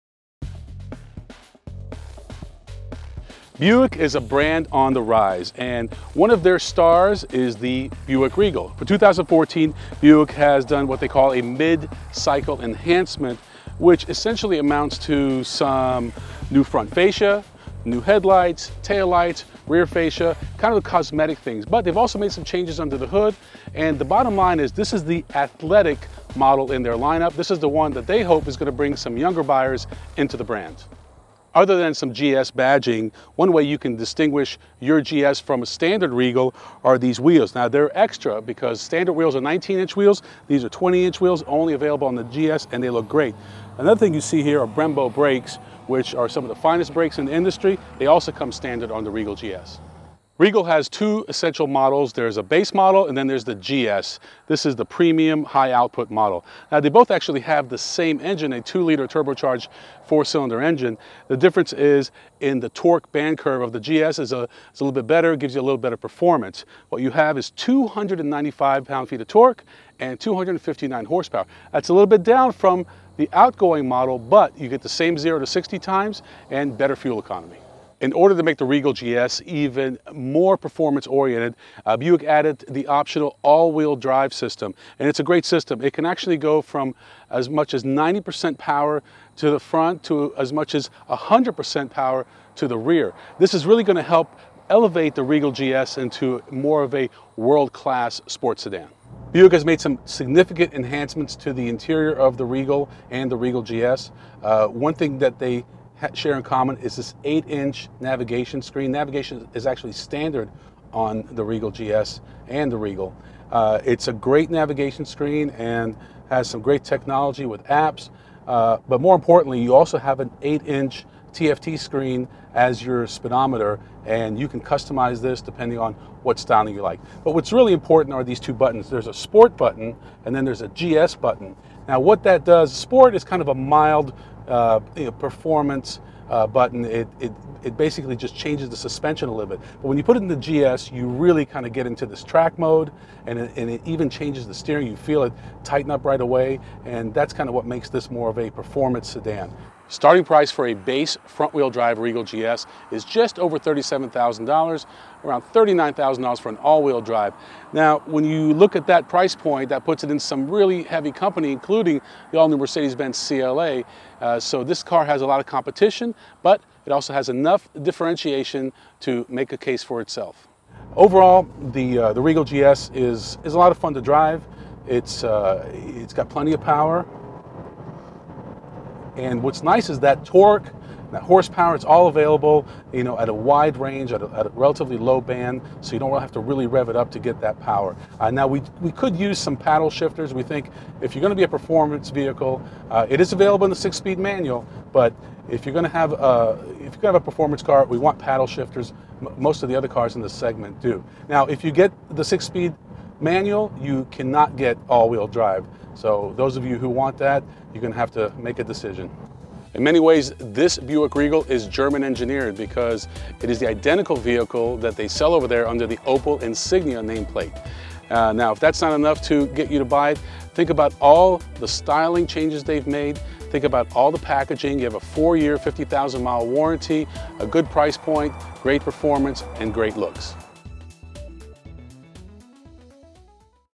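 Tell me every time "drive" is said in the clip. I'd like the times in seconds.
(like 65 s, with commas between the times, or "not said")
83 s, 151 s, 157 s, 174 s, 205 s.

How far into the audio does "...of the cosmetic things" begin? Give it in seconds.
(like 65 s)
20 s.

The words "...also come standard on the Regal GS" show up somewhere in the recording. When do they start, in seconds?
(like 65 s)
48 s.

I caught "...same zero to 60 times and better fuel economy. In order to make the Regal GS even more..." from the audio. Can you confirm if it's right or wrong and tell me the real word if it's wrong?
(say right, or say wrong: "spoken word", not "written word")
right.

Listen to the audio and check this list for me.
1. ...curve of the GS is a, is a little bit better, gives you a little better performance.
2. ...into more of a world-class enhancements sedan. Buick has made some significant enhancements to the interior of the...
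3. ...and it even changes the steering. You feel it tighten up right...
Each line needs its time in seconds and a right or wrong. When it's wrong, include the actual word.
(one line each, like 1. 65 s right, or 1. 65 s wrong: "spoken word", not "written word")
1. 63 s right
2. 95 s wrong: "sports", not "enhancements"
3. 143 s right.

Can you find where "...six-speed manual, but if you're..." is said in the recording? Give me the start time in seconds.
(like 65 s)
193 s.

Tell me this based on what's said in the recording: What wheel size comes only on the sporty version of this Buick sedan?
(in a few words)
20 inch.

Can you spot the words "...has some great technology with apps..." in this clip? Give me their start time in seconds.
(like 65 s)
116 s.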